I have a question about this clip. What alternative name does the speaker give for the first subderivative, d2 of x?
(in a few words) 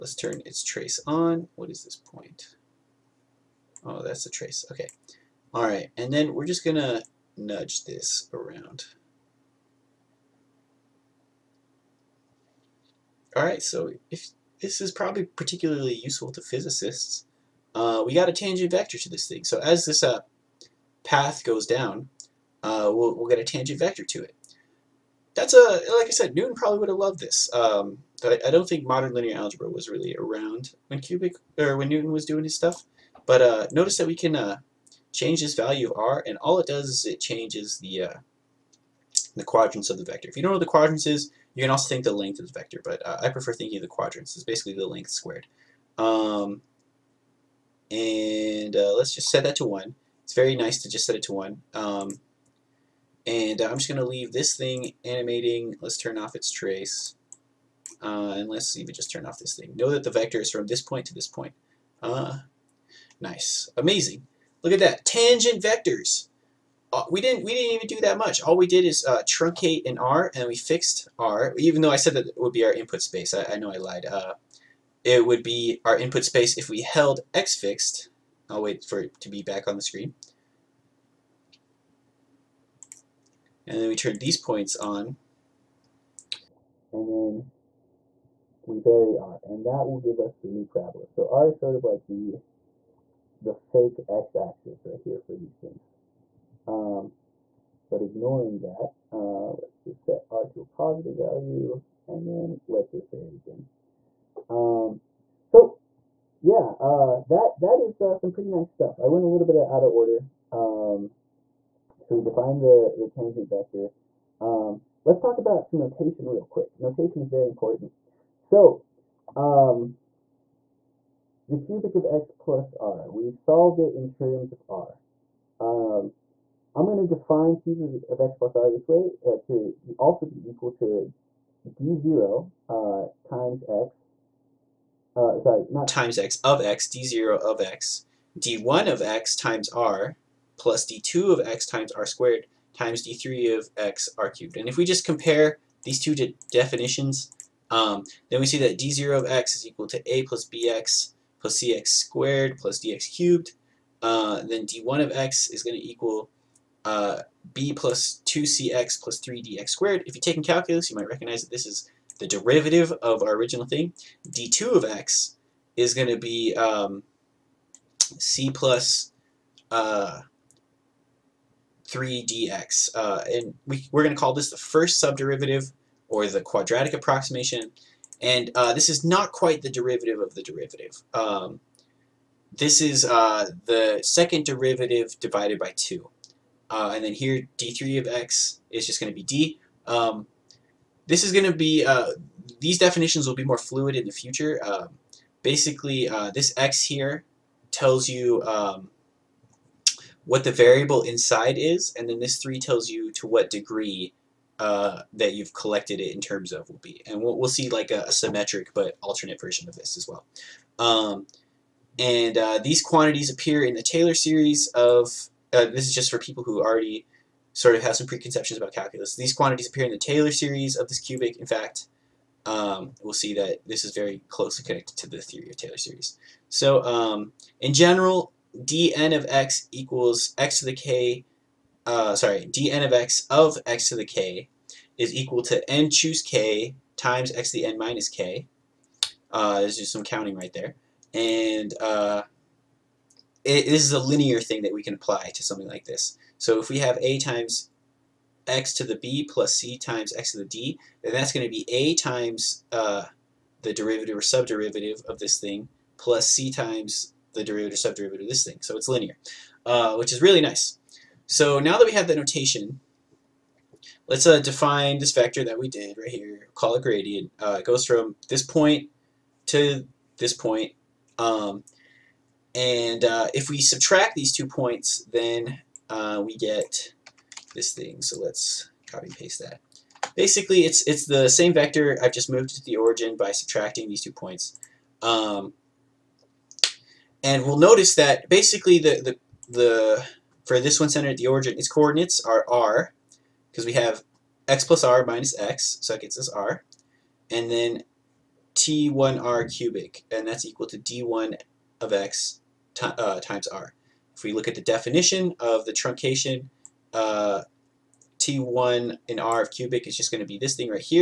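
quadratic approximation.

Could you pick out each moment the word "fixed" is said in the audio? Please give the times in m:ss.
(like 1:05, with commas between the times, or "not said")
1:10, 1:17.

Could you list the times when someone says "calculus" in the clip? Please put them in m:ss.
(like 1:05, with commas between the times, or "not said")
2:40, 3:38.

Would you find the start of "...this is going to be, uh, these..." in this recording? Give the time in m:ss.
3:11.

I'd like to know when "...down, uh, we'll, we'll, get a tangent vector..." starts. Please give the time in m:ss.
0:21.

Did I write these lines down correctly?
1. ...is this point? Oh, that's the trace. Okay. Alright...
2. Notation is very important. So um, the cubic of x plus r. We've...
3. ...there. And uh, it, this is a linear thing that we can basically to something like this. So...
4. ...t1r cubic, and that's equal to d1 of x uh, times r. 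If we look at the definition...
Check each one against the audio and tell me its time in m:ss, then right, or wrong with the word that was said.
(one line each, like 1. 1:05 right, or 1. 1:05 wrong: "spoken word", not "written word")
1. 0:01 right
2. 1:56 right
3. 4:00 wrong: "apply", not "basically"
4. 4:58 right.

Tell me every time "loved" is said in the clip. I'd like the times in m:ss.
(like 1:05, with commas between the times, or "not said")
0:26.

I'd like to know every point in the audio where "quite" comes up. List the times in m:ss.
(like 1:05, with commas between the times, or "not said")
2:59.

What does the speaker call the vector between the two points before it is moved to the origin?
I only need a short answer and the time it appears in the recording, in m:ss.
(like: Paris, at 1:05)
gradient, at 4:26.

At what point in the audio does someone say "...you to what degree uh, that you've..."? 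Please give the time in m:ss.
3:22.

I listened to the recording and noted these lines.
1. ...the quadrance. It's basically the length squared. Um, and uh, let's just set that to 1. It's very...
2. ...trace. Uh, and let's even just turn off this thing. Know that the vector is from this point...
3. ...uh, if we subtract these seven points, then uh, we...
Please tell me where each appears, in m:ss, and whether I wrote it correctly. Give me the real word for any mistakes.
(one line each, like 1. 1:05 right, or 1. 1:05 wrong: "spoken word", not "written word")
1. 0:43 right
2. 0:56 right
3. 4:33 wrong: "two", not "seven".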